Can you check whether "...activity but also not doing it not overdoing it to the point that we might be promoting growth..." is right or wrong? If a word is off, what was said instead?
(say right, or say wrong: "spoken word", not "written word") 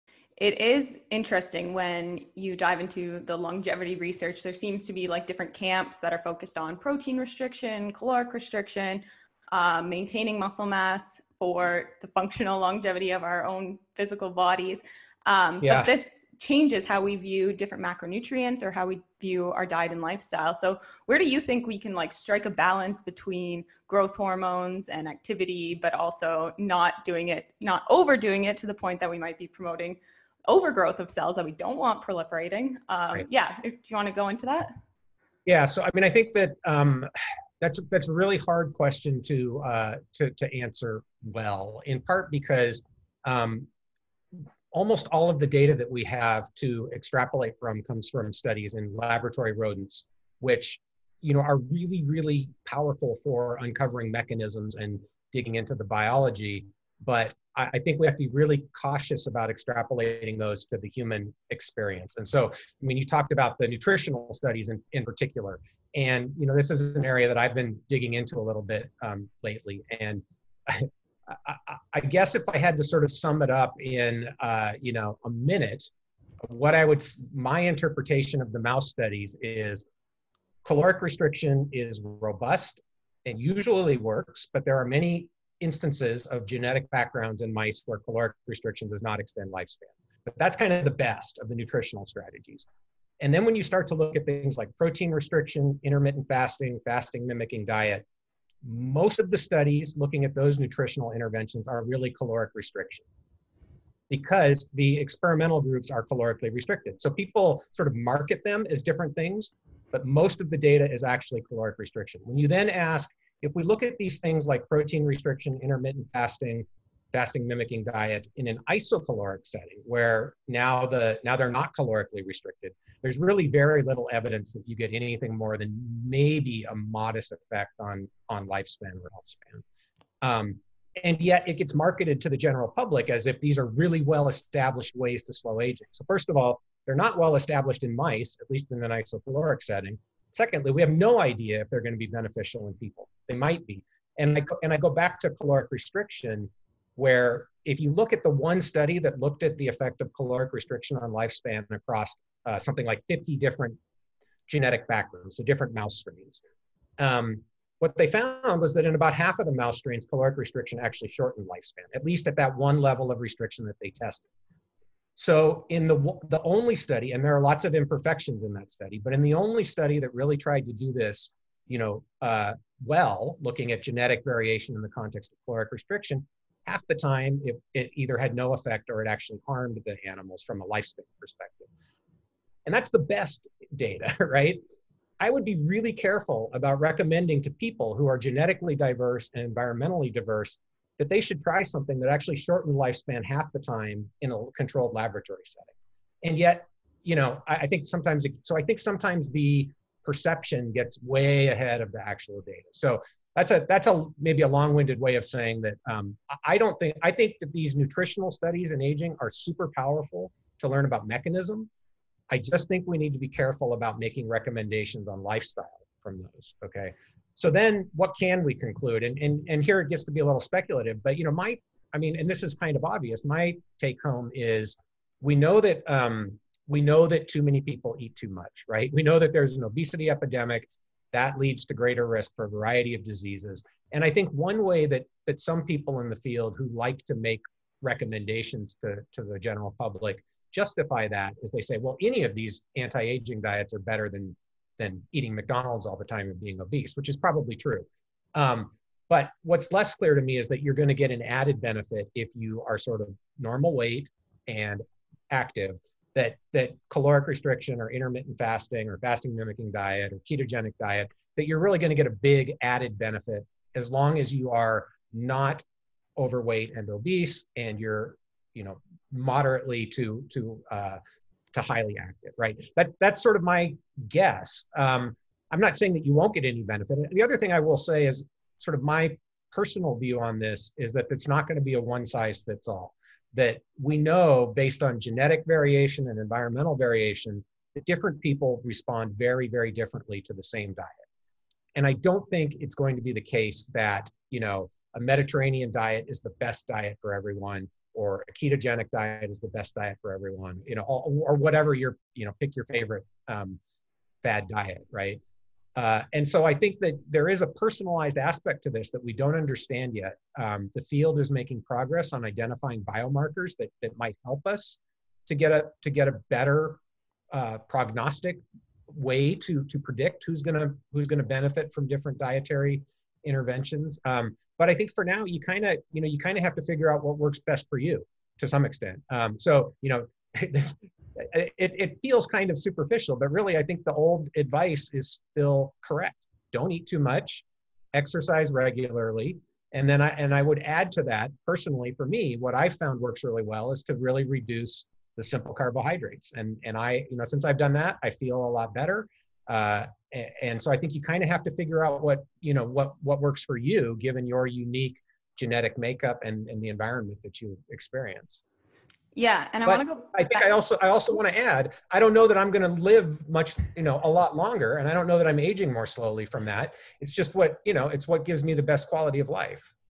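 wrong: "overgrowth", not "growth".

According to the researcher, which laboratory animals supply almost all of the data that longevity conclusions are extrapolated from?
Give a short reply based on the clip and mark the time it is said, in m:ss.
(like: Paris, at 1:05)
laboratory rodents, at 0:48.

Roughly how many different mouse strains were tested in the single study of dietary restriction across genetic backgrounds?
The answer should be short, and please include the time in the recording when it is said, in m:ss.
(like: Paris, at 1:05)
50, at 2:33.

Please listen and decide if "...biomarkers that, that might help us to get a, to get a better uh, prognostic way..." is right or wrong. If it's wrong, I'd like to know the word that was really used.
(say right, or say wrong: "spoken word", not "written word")
right.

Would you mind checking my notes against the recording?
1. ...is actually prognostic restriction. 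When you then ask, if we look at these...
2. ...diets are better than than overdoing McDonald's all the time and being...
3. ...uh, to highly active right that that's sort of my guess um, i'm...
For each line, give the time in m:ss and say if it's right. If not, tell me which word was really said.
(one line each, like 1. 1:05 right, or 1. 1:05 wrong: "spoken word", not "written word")
1. 1:50 wrong: "caloric", not "prognostic"
2. 4:03 wrong: "eating", not "overdoing"
3. 4:30 right.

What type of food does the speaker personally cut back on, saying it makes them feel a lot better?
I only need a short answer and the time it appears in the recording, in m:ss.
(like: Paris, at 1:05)
simple carbohydrates, at 5:45.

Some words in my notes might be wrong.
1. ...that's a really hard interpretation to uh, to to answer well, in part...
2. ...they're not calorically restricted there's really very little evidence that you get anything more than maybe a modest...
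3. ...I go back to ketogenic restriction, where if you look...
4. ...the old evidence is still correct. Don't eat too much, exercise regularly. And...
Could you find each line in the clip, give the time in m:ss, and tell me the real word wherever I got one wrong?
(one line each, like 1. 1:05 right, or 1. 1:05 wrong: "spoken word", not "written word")
1. 0:37 wrong: "question", not "interpretation"
2. 2:01 right
3. 2:24 wrong: "caloric", not "ketogenic"
4. 5:33 wrong: "advice", not "evidence".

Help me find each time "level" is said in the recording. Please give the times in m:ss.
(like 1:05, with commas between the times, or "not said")
2:42.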